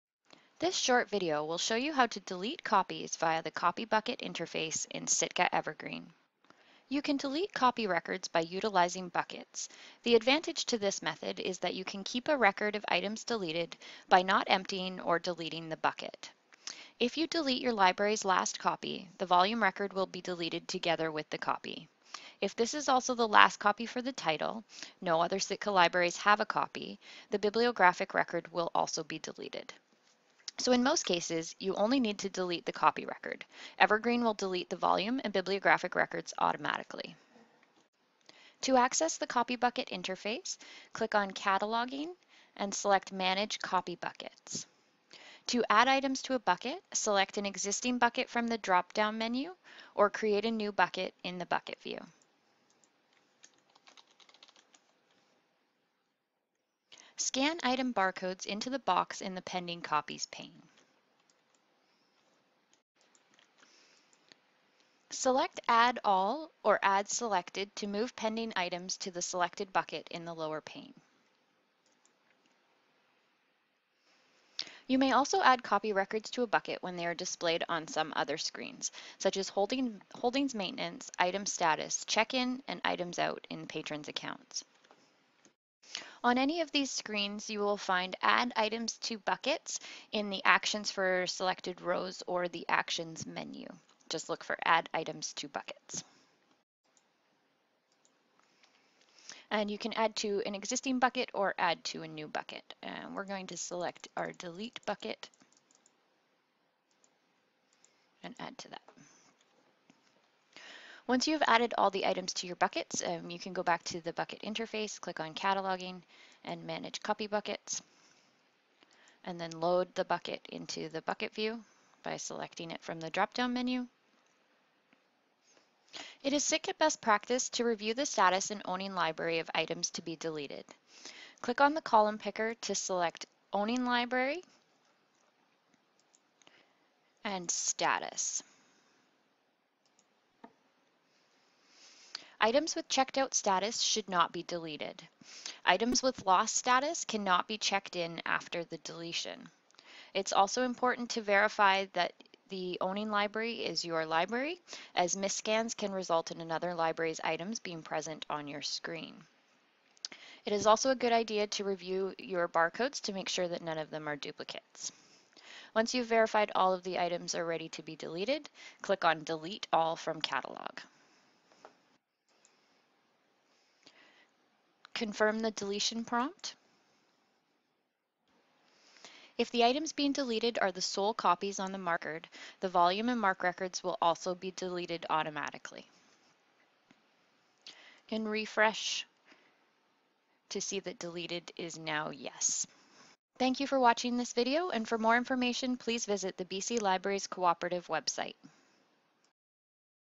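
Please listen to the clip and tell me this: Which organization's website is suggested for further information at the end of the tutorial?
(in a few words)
BC Libraries Cooperative.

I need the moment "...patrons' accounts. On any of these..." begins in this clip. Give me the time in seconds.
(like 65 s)
83 s.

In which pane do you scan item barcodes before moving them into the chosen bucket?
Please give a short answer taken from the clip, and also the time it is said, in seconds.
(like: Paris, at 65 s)
Pending Copies, at 59 s.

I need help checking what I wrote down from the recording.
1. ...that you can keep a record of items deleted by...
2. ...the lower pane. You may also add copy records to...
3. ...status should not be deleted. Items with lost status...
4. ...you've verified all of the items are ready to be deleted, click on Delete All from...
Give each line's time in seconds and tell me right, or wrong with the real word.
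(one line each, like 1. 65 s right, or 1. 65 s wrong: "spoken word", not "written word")
1. 11 s right
2. 70 s right
3. 143 s right
4. 165 s right.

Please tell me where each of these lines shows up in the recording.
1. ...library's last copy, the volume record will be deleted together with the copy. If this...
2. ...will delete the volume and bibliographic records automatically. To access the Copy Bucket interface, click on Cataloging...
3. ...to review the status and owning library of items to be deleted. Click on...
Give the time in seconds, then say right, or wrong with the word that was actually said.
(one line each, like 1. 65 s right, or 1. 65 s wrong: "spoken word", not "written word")
1. 17 s right
2. 34 s right
3. 127 s right.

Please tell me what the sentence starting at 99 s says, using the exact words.
And you can add to an existing bucket or add to a new bucket.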